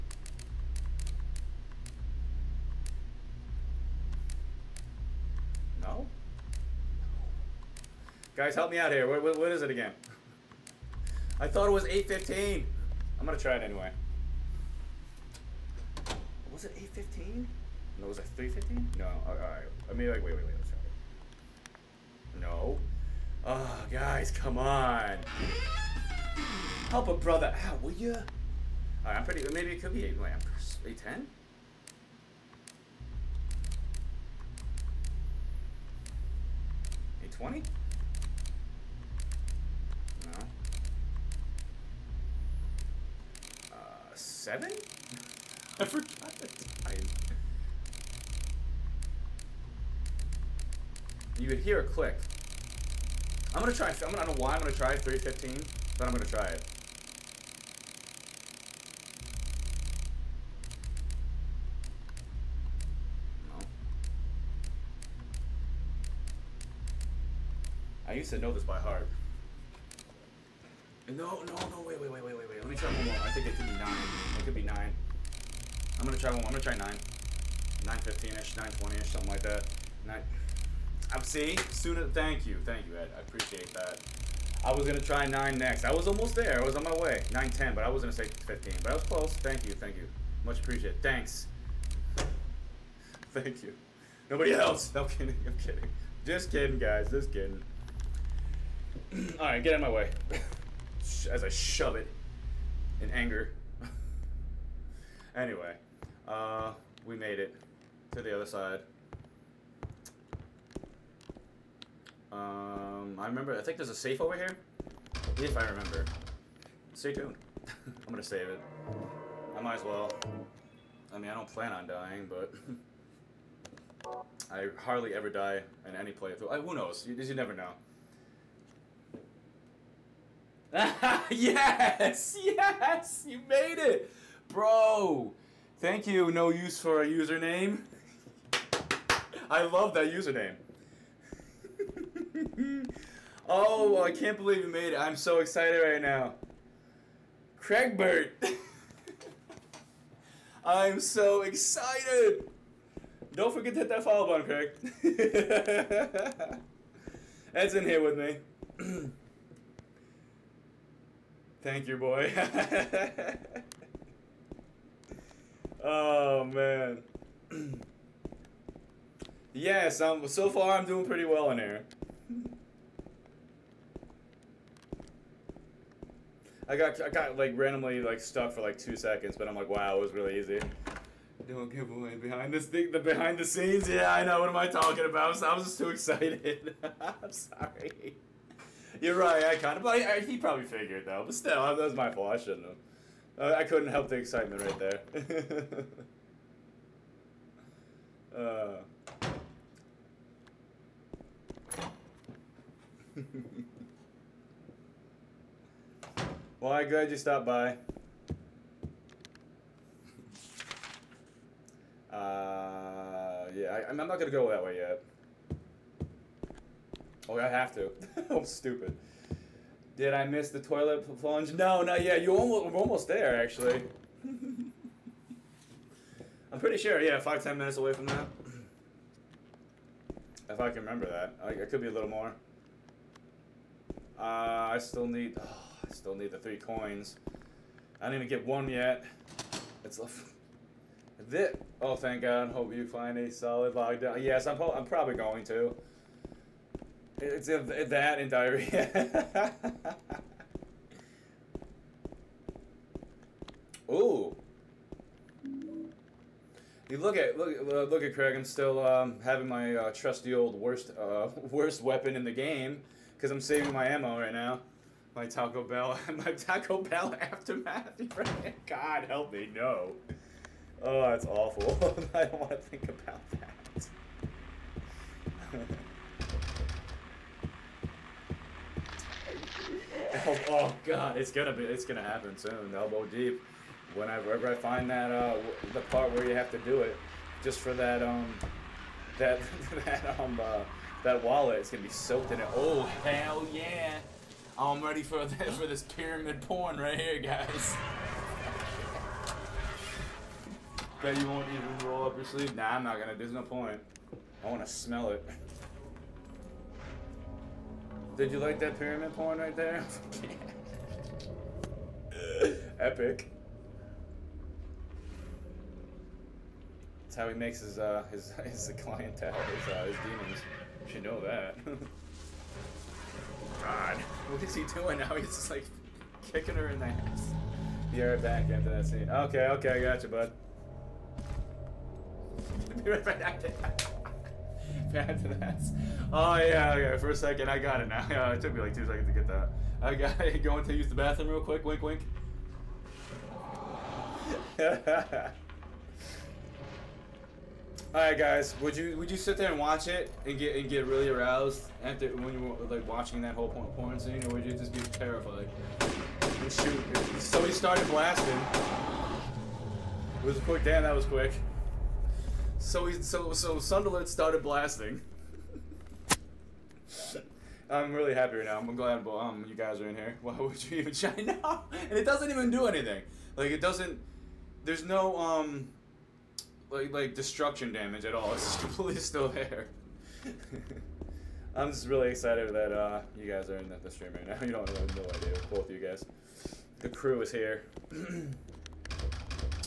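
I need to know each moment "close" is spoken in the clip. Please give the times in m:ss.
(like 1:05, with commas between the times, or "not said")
1:29.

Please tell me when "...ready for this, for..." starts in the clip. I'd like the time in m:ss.
4:54.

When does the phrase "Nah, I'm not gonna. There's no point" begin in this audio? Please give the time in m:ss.
5:02.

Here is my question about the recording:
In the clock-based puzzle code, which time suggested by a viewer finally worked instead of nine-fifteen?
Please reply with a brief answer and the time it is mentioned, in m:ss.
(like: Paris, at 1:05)
9:10, at 1:27.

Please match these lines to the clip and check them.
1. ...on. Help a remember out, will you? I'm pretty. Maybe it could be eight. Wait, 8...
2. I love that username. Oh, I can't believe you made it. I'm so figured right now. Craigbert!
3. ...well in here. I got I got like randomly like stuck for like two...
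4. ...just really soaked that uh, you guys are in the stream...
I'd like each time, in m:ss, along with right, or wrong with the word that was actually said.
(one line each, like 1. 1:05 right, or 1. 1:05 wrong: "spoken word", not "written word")
1. 0:24 wrong: "brother", not "remember"
2. 2:19 wrong: "excited", not "figured"
3. 2:51 right
4. 6:21 wrong: "excited", not "soaked".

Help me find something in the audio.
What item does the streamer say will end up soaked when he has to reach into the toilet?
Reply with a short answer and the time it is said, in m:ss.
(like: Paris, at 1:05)
wallet, at 4:51.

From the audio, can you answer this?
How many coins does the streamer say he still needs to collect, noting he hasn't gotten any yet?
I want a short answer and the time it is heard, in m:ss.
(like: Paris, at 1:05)
3, at 3:56.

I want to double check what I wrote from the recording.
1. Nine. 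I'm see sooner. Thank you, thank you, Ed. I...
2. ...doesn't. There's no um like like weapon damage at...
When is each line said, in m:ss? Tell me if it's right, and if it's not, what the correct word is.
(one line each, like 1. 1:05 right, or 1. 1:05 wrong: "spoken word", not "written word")
1. 1:20 right
2. 6:13 wrong: "destruction", not "weapon".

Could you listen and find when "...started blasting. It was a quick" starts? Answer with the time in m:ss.
5:57.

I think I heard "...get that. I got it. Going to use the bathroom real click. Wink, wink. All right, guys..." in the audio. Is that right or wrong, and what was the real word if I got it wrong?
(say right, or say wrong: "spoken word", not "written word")
wrong: "quick", not "click".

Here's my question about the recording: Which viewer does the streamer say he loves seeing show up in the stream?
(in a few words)
no use for a username.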